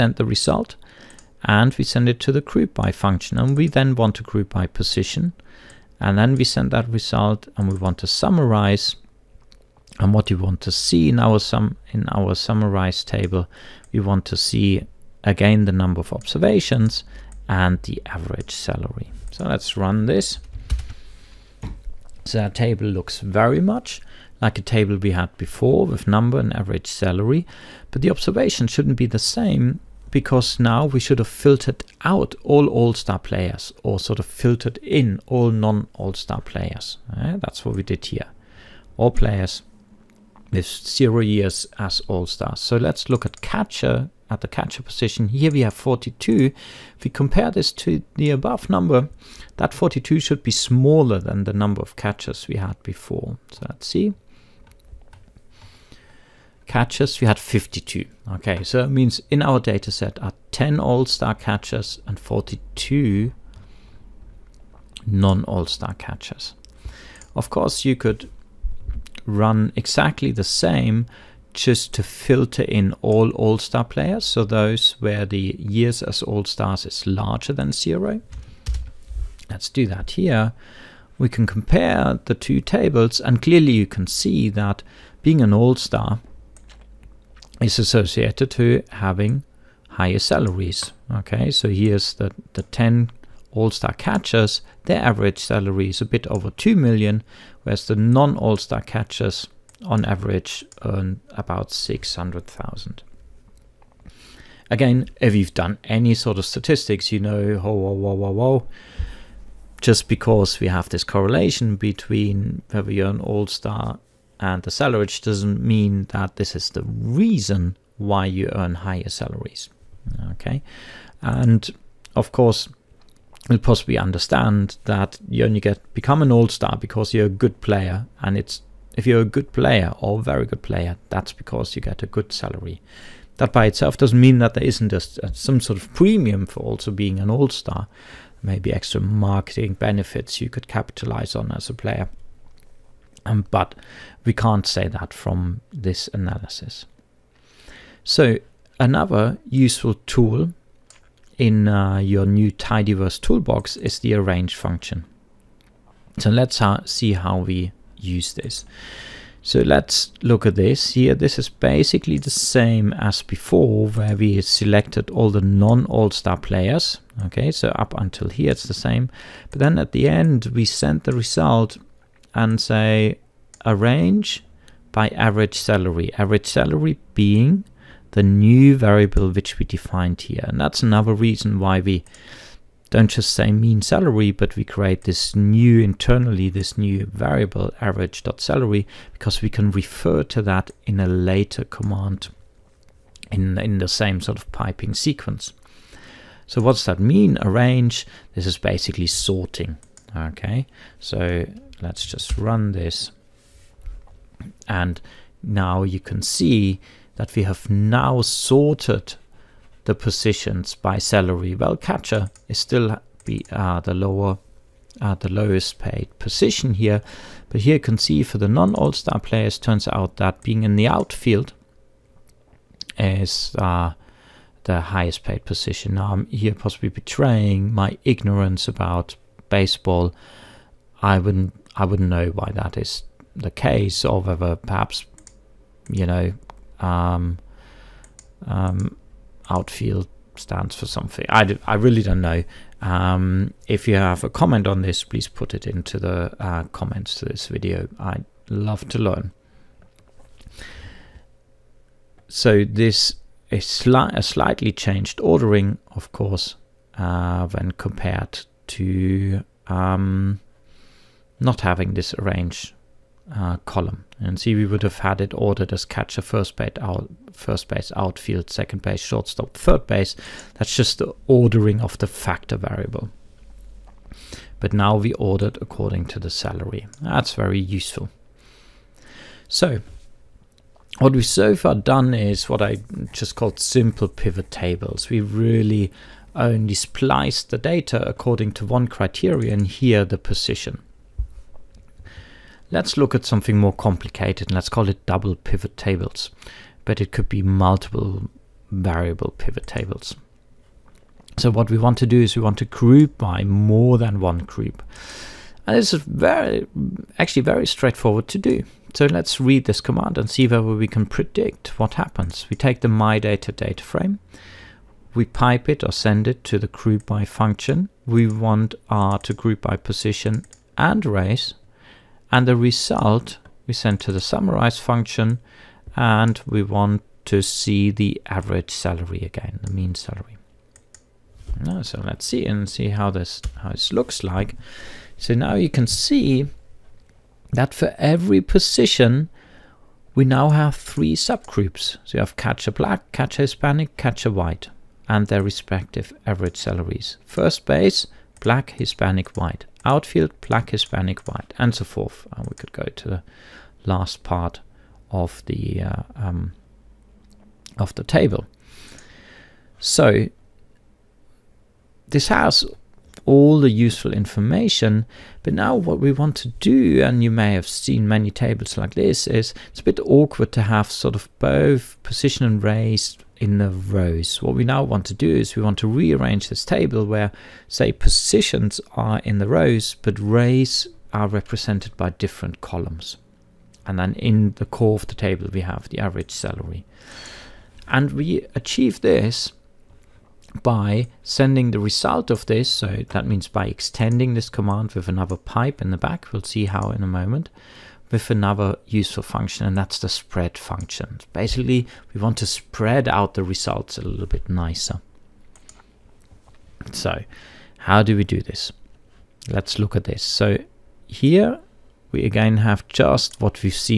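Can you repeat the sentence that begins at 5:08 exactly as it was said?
So let's read this command and see whether we can predict what happens.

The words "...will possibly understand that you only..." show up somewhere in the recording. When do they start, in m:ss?
2:03.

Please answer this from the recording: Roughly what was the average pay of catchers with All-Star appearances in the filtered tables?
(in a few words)
a bit over 2 million.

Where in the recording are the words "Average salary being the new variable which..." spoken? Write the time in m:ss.
2:56.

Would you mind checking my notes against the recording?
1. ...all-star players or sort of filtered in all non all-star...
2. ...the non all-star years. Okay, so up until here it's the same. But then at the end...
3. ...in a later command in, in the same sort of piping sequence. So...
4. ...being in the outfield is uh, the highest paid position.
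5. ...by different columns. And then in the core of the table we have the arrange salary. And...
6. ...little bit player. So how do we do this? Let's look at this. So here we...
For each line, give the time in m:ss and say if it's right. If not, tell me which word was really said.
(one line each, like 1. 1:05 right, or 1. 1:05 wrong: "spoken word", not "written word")
1. 0:32 right
2. 2:45 wrong: "players", not "years"
3. 3:10 right
4. 3:40 right
5. 6:21 wrong: "average", not "arrange"
6. 6:44 wrong: "nicer", not "player".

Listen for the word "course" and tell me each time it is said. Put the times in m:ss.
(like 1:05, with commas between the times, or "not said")
1:07, 2:02, 4:16.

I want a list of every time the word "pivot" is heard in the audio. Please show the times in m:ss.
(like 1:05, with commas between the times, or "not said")
4:44, 4:55, 4:59.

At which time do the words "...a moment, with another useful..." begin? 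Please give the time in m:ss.
6:37.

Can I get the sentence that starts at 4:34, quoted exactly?
But now we ordered according to the salary.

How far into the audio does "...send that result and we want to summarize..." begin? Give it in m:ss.
0:06.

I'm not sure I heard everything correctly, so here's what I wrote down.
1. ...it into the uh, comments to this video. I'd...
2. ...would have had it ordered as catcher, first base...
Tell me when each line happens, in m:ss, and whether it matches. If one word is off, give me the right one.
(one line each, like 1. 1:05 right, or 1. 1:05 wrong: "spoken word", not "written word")
1. 4:05 right
2. 4:24 right.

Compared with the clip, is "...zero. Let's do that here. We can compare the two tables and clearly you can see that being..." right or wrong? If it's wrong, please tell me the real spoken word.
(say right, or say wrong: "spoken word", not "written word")
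right.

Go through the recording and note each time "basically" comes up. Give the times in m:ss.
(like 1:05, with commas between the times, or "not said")
2:41, 3:18, 6:41.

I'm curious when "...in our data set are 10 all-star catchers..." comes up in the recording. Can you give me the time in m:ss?
0:59.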